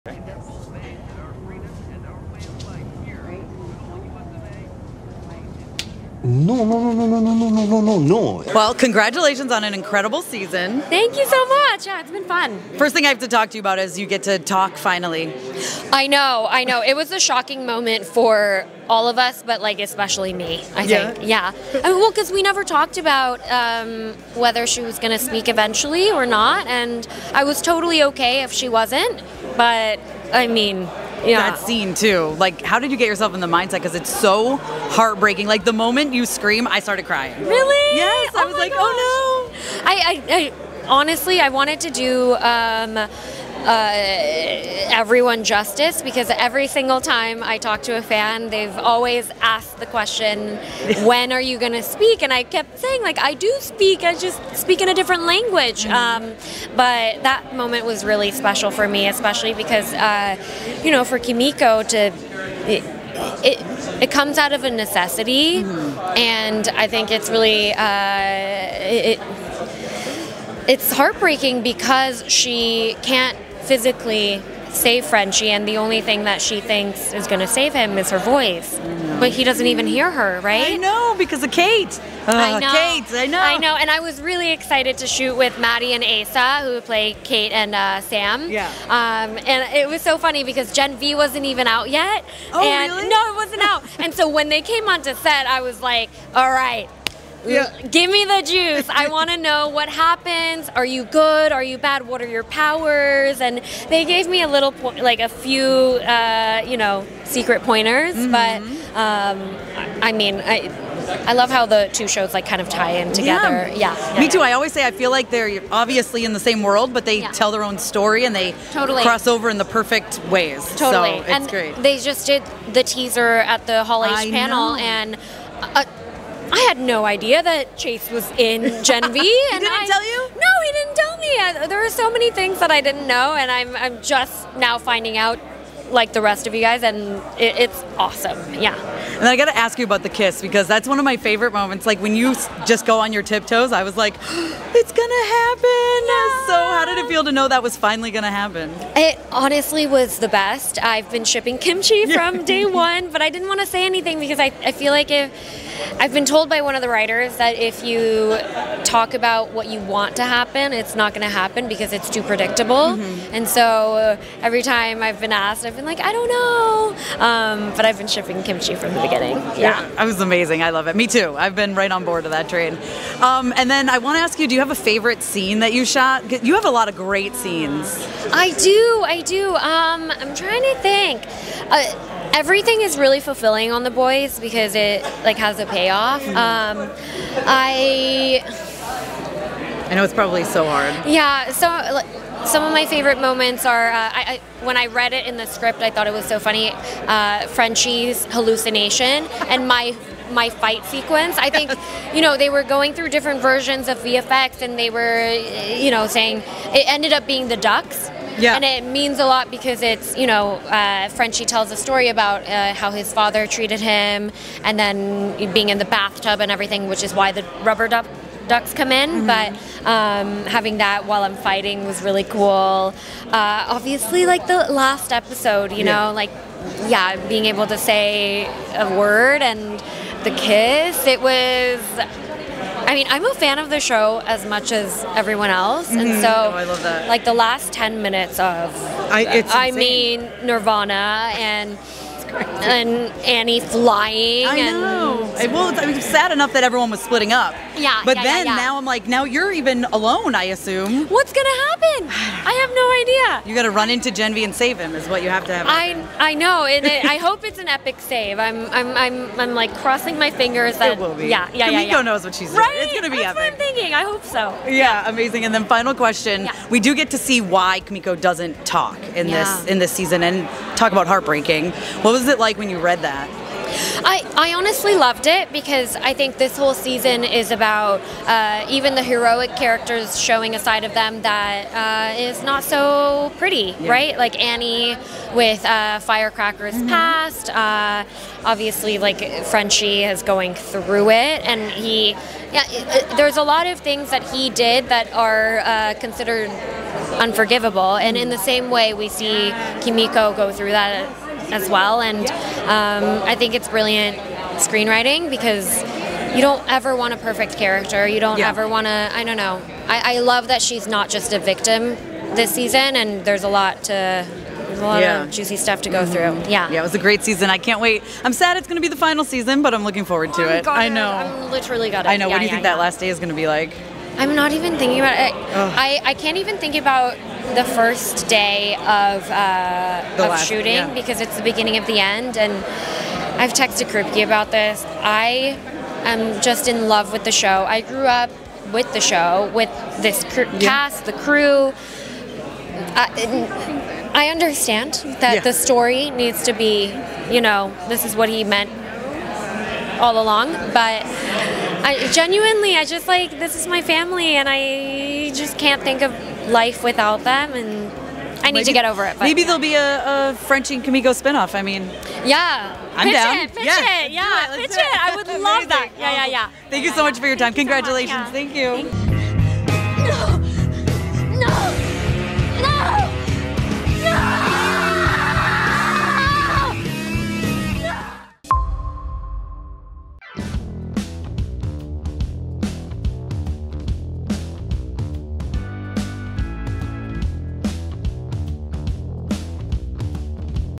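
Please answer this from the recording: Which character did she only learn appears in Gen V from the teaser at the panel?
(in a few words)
Chase.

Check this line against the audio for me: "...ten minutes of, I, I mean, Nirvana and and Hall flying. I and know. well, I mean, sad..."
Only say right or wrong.
wrong.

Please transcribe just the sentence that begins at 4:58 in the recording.
And in the same way, we see Kimiko go through that as well.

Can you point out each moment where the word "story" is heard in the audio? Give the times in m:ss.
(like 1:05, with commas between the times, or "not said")
1:57, 3:31, 5:45.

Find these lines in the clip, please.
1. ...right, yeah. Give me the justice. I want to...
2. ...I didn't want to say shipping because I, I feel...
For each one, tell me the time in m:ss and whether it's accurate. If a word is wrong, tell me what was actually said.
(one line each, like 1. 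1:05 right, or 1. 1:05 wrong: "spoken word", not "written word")
1. 1:36 wrong: "juice", not "justice"
2. 2:33 wrong: "anything", not "shipping".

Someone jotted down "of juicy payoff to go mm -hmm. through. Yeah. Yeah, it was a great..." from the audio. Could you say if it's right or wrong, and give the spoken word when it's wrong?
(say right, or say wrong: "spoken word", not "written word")
wrong: "stuff", not "payoff".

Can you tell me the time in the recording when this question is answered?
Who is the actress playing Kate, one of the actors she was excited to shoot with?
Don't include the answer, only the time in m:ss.
1:25.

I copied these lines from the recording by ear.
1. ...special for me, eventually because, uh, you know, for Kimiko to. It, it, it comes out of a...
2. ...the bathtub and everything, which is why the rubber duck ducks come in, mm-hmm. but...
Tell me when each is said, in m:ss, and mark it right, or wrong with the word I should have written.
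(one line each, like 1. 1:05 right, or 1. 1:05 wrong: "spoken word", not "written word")
1. 0:58 wrong: "especially", not "eventually"
2. 3:35 right.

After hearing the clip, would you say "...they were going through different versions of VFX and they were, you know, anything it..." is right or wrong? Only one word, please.
wrong.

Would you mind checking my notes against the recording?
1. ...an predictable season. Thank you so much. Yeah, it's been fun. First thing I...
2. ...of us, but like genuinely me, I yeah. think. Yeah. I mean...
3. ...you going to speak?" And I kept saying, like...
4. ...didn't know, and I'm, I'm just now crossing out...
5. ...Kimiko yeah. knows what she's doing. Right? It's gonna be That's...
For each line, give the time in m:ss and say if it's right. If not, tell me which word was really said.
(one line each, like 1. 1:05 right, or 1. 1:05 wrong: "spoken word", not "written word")
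1. 0:09 wrong: "incredible", not "predictable"
2. 0:19 wrong: "especially", not "genuinely"
3. 0:51 right
4. 2:12 wrong: "finding", not "crossing"
5. 4:21 right.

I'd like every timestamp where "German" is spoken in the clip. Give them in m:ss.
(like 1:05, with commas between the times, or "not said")
not said.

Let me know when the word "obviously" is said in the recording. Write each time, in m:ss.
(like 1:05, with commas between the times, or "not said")
1:55, 3:43, 4:48.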